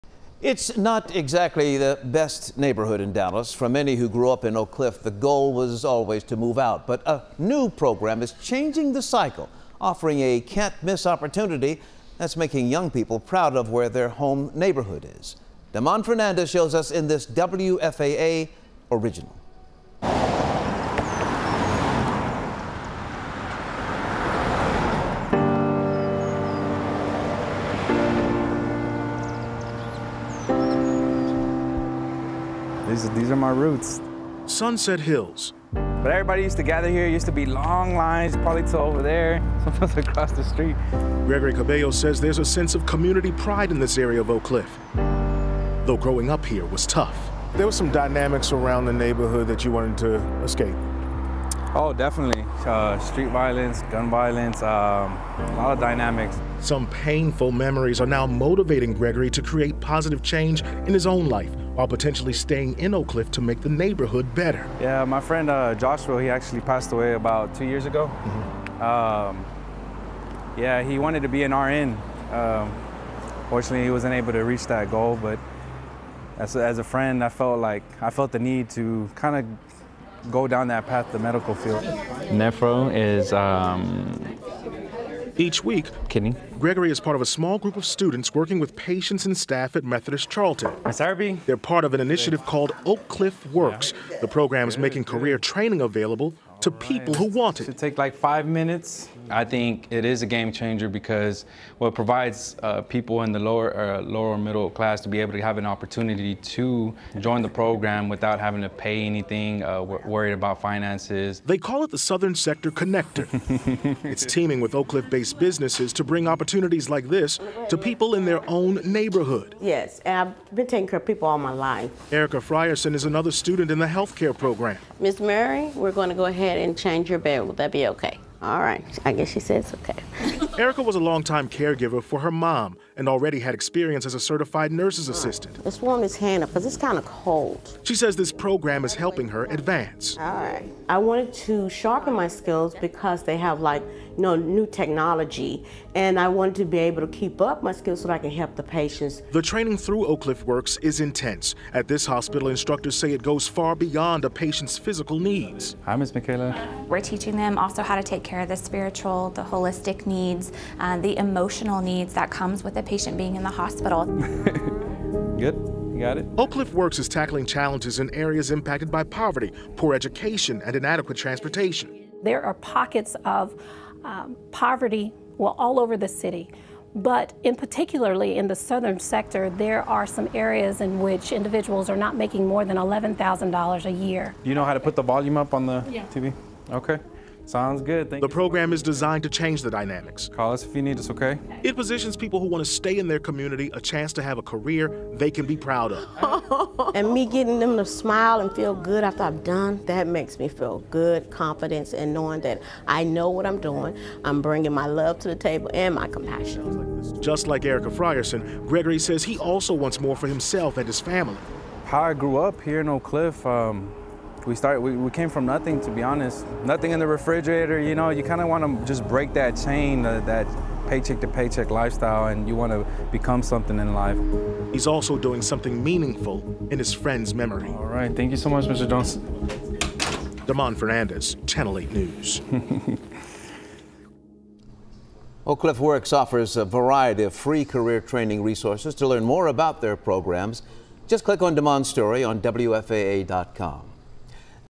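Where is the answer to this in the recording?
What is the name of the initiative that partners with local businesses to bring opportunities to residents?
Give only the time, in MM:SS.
01:51.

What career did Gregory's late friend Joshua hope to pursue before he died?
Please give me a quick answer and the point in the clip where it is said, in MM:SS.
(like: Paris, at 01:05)
RN, at 01:11.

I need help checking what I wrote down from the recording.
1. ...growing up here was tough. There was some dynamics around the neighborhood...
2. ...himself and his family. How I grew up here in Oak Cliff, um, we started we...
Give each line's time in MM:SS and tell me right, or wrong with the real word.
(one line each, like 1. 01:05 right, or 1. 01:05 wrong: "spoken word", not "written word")
1. 00:45 right
2. 03:30 right.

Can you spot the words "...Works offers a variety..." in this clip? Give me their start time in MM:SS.
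03:55.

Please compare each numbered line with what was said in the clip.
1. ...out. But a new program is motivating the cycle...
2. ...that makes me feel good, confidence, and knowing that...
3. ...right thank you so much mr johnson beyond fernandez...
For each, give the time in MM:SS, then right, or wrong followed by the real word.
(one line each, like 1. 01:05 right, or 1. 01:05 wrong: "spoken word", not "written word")
1. 00:06 wrong: "changing", not "motivating"
2. 03:19 right
3. 03:47 wrong: "demond", not "beyond".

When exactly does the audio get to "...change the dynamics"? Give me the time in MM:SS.
03:09.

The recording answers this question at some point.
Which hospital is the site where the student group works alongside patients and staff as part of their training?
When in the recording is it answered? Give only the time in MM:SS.
01:29.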